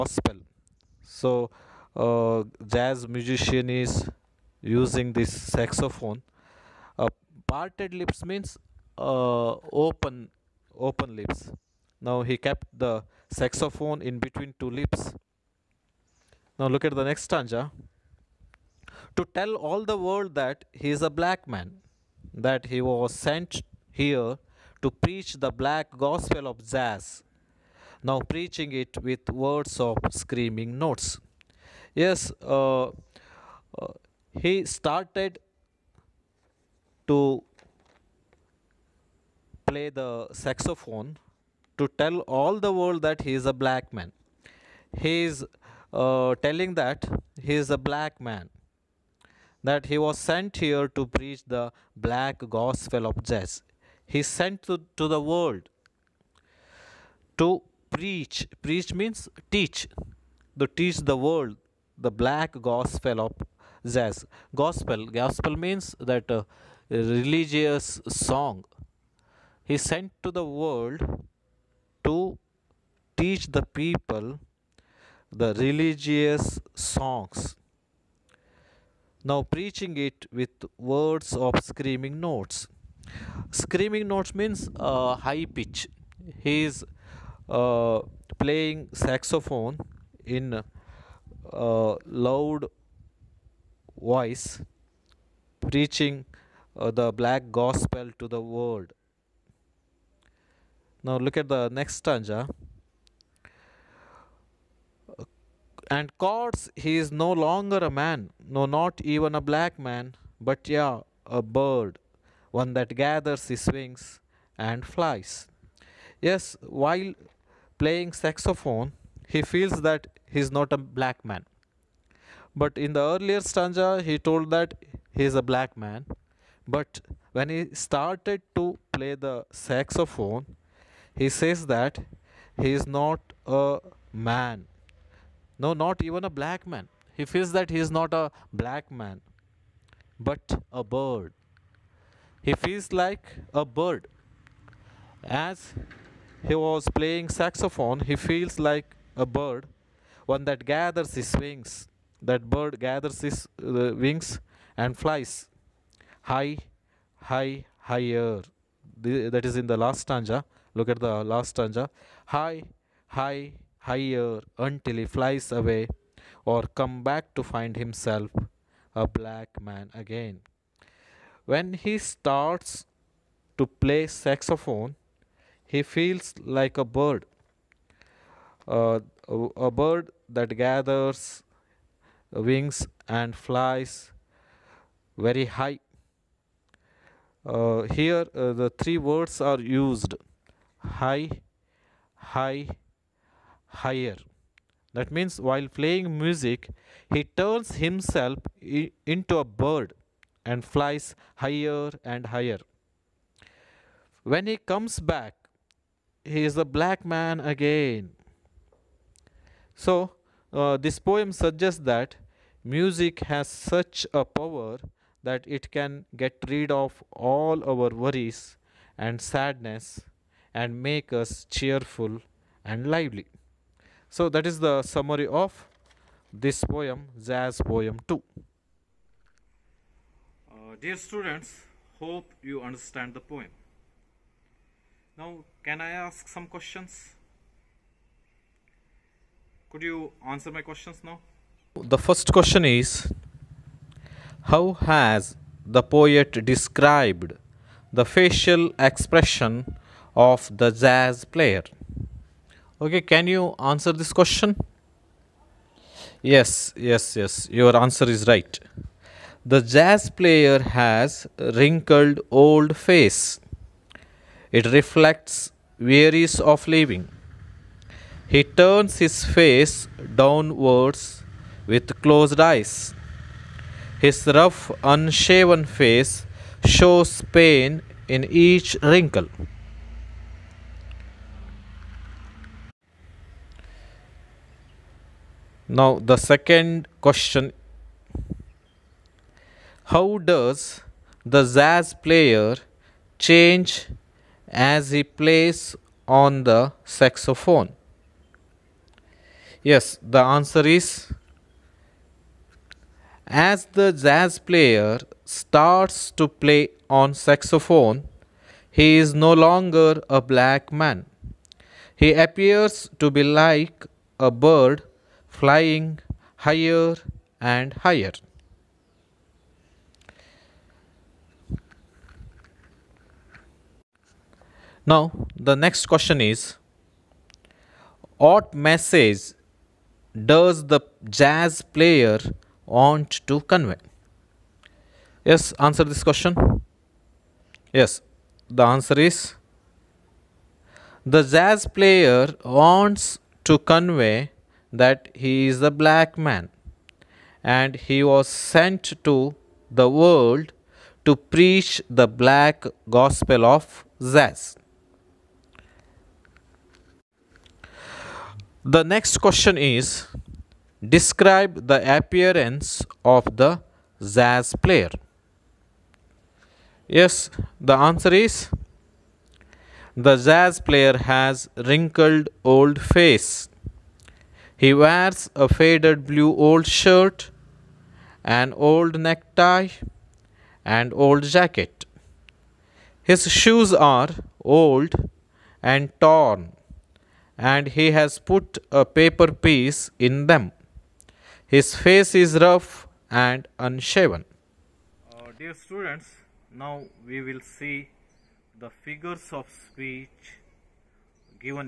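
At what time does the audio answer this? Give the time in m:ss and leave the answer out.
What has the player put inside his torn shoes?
6:28.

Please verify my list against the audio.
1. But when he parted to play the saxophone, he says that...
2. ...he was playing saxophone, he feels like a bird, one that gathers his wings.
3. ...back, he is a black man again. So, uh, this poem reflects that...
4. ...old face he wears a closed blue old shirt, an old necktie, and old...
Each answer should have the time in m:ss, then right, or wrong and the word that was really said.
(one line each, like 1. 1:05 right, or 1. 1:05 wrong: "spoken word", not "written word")
1. 2:06 wrong: "started", not "parted"
2. 2:26 right
3. 3:25 wrong: "suggests", not "reflects"
4. 6:12 wrong: "faded", not "closed".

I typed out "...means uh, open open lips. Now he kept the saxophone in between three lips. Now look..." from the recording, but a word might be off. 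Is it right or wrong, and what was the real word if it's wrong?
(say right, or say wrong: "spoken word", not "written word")
wrong: "two", not "three".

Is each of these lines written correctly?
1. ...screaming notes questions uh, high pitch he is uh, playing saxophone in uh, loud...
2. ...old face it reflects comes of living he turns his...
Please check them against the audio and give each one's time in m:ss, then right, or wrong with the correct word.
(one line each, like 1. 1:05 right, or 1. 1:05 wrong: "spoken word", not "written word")
1. 1:23 wrong: "means", not "questions"
2. 4:22 wrong: "wearies", not "comes".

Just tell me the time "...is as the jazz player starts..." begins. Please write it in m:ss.
5:00.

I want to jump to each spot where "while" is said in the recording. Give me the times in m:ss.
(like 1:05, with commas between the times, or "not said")
1:56, 3:15.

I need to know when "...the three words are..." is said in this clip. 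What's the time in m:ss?
3:08.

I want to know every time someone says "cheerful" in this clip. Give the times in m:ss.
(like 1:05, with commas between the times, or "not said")
3:41.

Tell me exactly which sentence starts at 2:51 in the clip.
When he starts to play saxophone, he feels like a bird.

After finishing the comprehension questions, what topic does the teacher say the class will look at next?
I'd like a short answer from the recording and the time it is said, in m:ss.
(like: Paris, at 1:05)
Figures of speech, at 6:38.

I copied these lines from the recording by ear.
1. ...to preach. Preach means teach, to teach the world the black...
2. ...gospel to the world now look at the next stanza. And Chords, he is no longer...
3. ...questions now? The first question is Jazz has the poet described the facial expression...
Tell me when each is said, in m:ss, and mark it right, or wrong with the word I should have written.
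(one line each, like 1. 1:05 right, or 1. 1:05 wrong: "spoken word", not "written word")
1. 0:57 right
2. 1:37 right
3. 4:00 wrong: "How", not "Jazz".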